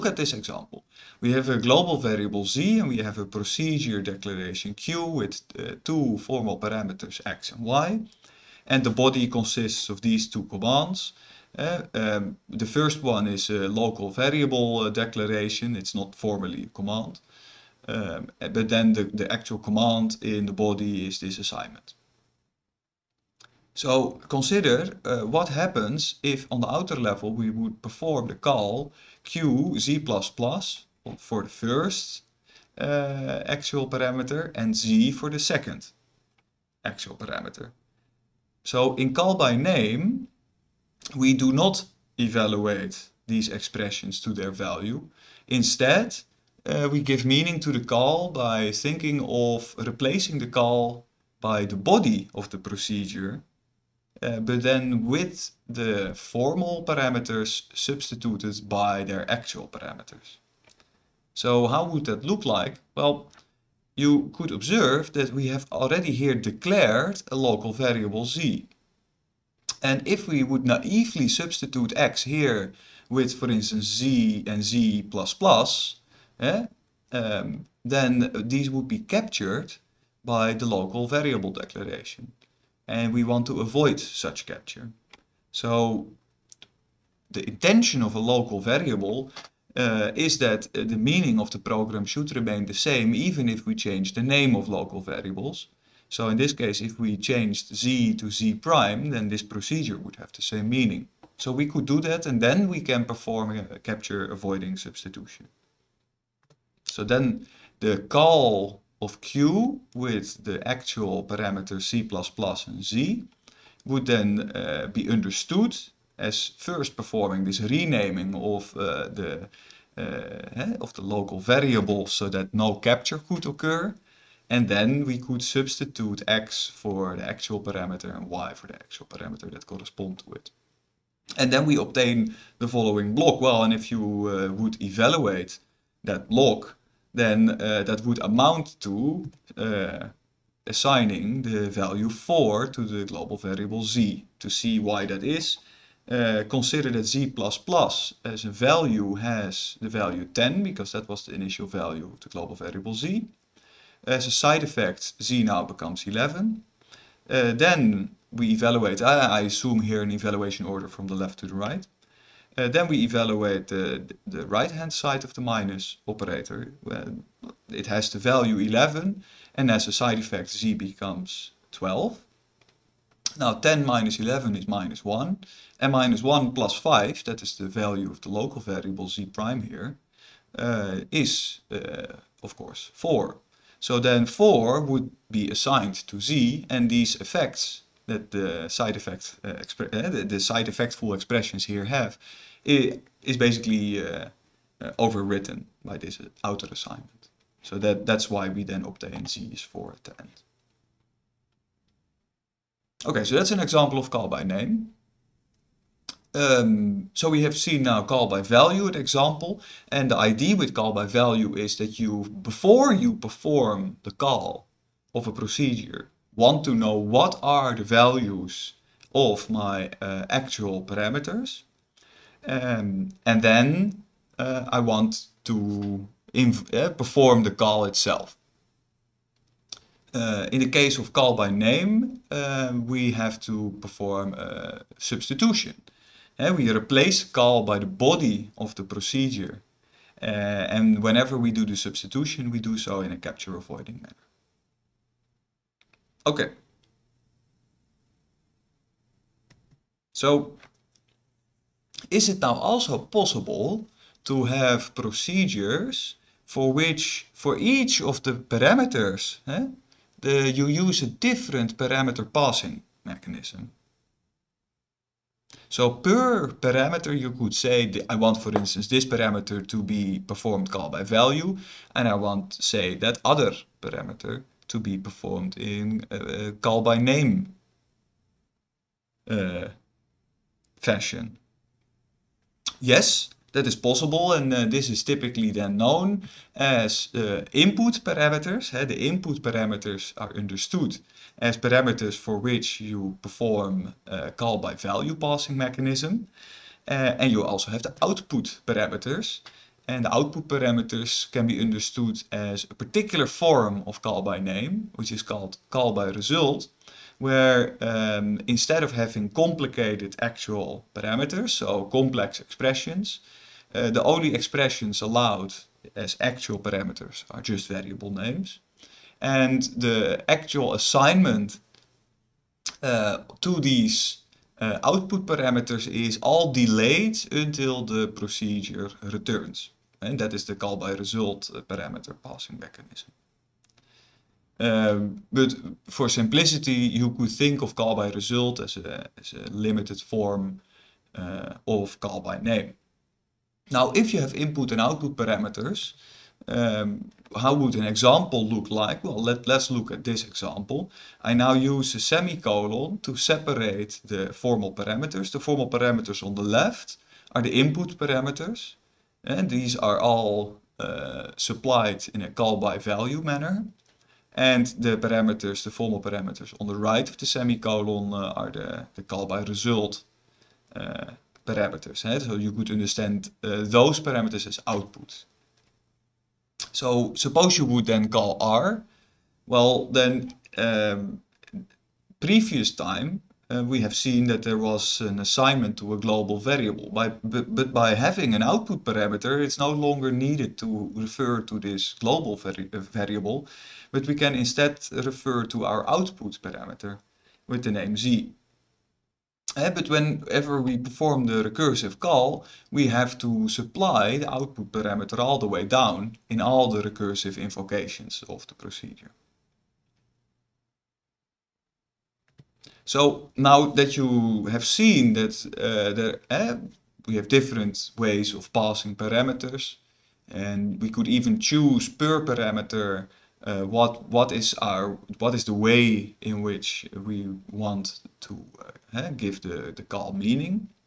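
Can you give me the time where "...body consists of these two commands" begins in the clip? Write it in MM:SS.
00:08.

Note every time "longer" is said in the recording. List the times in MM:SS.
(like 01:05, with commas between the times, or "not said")
06:29.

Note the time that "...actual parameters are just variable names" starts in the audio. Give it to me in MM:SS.
05:16.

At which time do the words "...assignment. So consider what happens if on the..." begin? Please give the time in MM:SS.
00:21.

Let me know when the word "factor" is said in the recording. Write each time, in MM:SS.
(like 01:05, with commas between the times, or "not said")
not said.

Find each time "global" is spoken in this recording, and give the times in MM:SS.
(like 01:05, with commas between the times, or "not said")
00:01, 02:23, 02:32, 06:25, 06:31.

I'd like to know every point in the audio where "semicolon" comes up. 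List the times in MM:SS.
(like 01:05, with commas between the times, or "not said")
05:51, 06:07.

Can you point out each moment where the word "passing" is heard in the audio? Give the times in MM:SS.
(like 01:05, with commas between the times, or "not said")
04:22, 04:55, 05:32, 06:58.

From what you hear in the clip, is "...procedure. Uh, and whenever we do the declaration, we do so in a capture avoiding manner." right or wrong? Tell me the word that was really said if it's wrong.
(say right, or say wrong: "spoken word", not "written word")
wrong: "substitution", not "declaration".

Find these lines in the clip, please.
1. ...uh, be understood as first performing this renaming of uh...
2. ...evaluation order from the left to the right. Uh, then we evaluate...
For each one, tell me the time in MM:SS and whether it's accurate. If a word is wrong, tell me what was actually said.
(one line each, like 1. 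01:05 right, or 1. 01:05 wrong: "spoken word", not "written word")
1. 01:54 right
2. 02:40 right.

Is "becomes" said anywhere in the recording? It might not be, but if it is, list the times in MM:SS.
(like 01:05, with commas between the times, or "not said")
02:35, 02:50.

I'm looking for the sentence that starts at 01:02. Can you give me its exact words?
Well, you could observe that we have already here declared a local variable z.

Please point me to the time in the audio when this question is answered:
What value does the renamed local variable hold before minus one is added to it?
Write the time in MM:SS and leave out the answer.
02:56.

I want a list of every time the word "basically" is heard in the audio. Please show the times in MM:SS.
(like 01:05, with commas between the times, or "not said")
03:13.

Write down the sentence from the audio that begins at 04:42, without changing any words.
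Yes, that is possible and uh, this is typically then known as uh, input parameters.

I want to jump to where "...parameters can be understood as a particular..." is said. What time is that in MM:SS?
05:00.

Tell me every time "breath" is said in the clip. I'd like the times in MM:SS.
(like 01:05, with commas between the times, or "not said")
not said.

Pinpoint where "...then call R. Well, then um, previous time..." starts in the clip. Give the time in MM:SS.
06:17.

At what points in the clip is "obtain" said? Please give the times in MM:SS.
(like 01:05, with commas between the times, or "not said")
02:11, 03:18.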